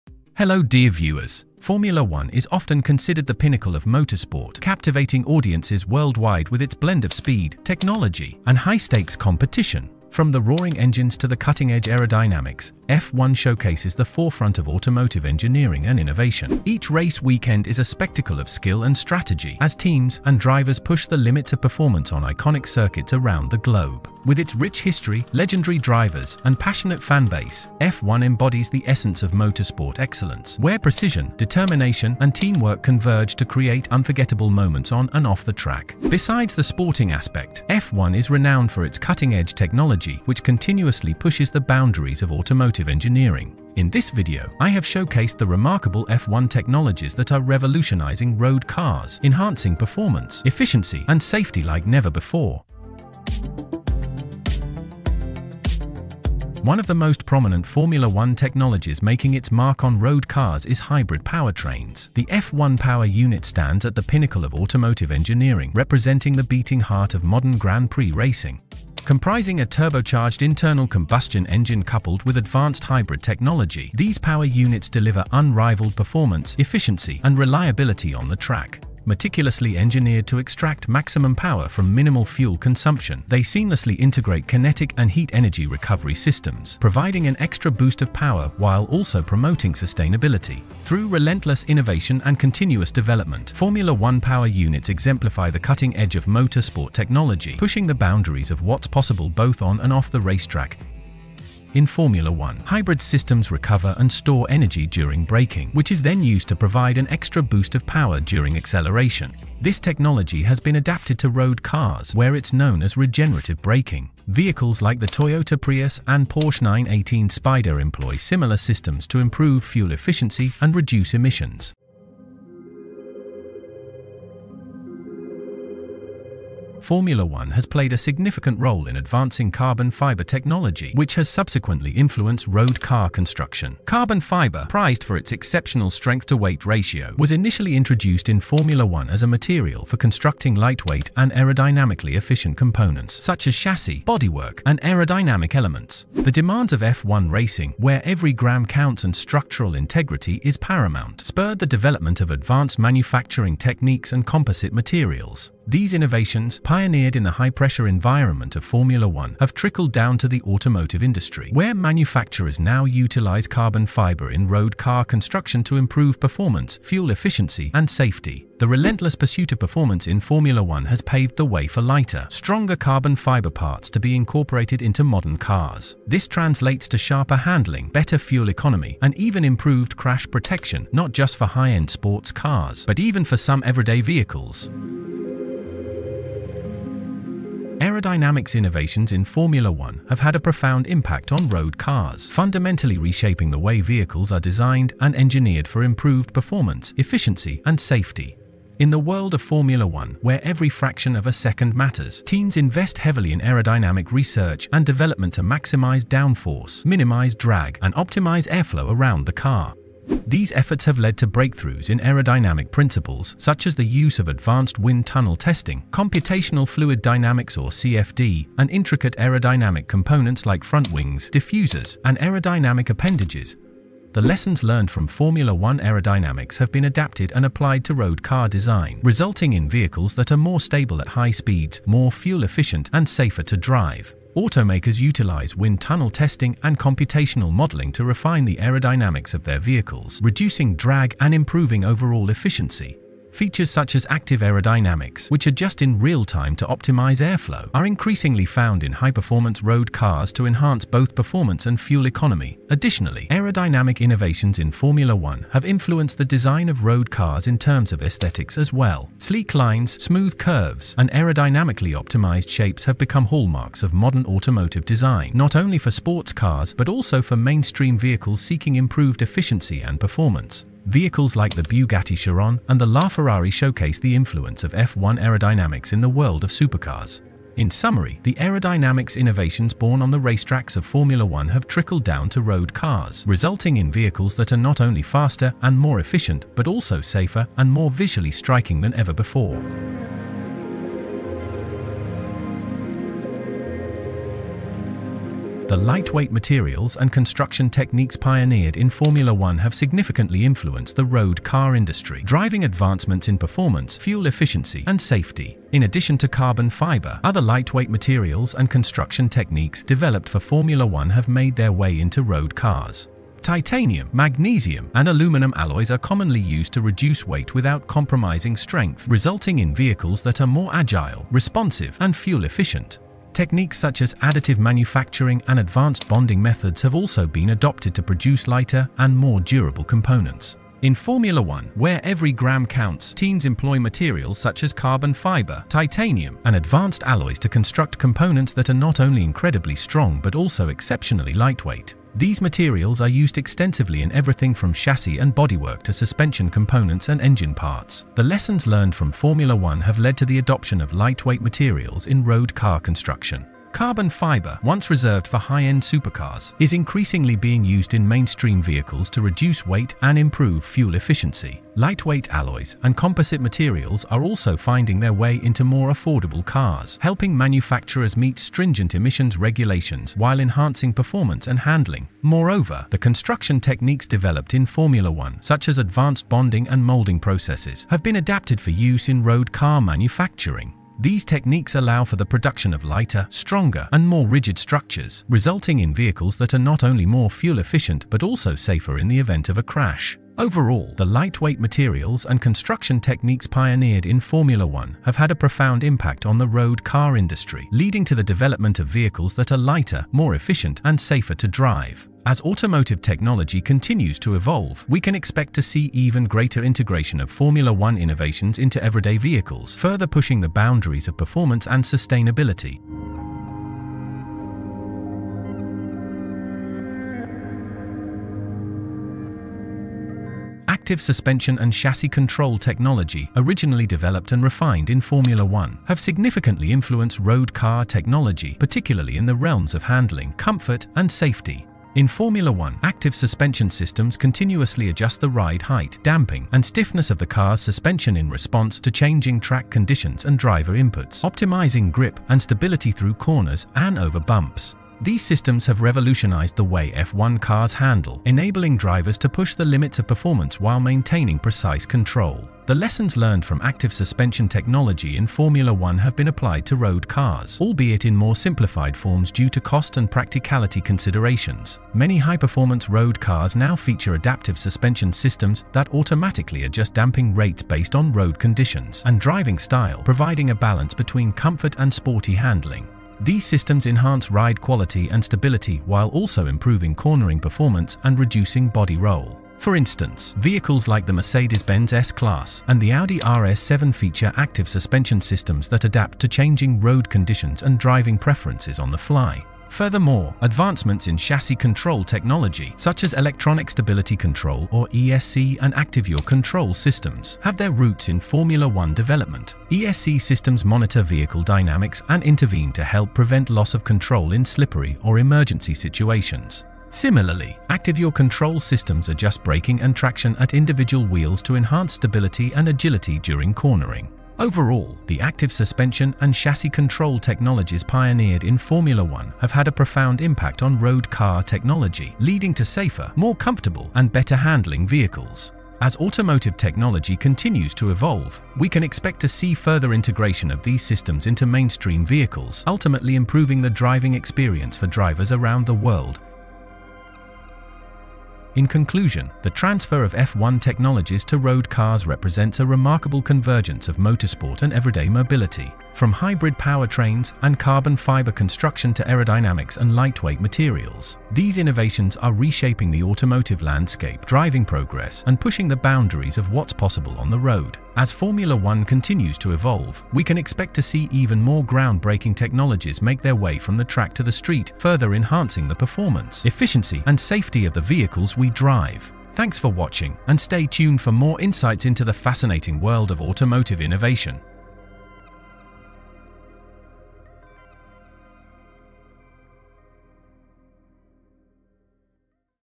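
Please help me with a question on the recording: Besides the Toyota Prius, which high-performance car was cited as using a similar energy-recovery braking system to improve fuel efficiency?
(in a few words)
Porsche 918 Spider.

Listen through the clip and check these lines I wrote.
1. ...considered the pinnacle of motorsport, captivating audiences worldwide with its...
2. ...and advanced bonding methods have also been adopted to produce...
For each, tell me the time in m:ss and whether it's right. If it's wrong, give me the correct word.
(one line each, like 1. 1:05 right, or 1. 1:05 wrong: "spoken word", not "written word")
1. 0:02 right
2. 5:25 right.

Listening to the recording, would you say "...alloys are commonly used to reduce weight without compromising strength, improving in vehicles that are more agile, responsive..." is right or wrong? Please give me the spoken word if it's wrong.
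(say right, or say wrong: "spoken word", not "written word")
wrong: "resulting", not "improving".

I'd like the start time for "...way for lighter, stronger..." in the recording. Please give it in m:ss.
2:51.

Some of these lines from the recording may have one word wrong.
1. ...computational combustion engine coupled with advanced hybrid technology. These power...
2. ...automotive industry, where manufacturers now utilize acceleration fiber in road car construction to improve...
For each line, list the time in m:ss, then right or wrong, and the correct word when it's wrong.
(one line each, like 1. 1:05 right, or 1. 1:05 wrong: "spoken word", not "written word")
1. 1:10 wrong: "internal", not "computational"
2. 2:40 wrong: "carbon", not "acceleration".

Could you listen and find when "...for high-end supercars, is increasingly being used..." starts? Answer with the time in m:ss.
5:55.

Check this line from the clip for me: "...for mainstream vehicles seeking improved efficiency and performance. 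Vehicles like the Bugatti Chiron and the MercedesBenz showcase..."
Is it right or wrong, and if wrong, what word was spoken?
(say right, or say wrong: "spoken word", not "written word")
wrong: "LaFerrari", not "MercedesBenz".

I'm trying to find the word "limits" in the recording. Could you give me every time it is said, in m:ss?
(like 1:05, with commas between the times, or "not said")
0:21, 7:29.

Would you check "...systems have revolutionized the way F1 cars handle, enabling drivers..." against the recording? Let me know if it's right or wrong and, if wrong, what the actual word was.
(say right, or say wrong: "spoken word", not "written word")
right.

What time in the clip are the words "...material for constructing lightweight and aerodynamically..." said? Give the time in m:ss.
2:19.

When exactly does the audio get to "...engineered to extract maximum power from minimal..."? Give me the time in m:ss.
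1:19.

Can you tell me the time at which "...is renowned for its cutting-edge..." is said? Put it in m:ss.
0:38.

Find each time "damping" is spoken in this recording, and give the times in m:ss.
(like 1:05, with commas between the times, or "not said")
7:16, 7:46.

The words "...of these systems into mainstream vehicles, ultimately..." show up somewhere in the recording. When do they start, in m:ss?
8:50.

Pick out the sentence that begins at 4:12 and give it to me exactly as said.
Additionally, aerodynamic innovations in Formula One have influenced the design of road cars in terms of aesthetics as well.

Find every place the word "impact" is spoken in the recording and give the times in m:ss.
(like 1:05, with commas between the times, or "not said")
3:10, 6:35, 8:40.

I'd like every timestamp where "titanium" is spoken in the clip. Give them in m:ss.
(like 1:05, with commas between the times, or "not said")
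5:13, 5:35.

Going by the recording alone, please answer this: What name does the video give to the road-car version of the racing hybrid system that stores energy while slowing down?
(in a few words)
Regenerative braking.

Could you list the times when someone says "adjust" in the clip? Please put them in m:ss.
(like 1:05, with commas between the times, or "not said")
4:05, 7:14, 7:46, 8:29.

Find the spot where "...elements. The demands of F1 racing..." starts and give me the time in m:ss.
2:25.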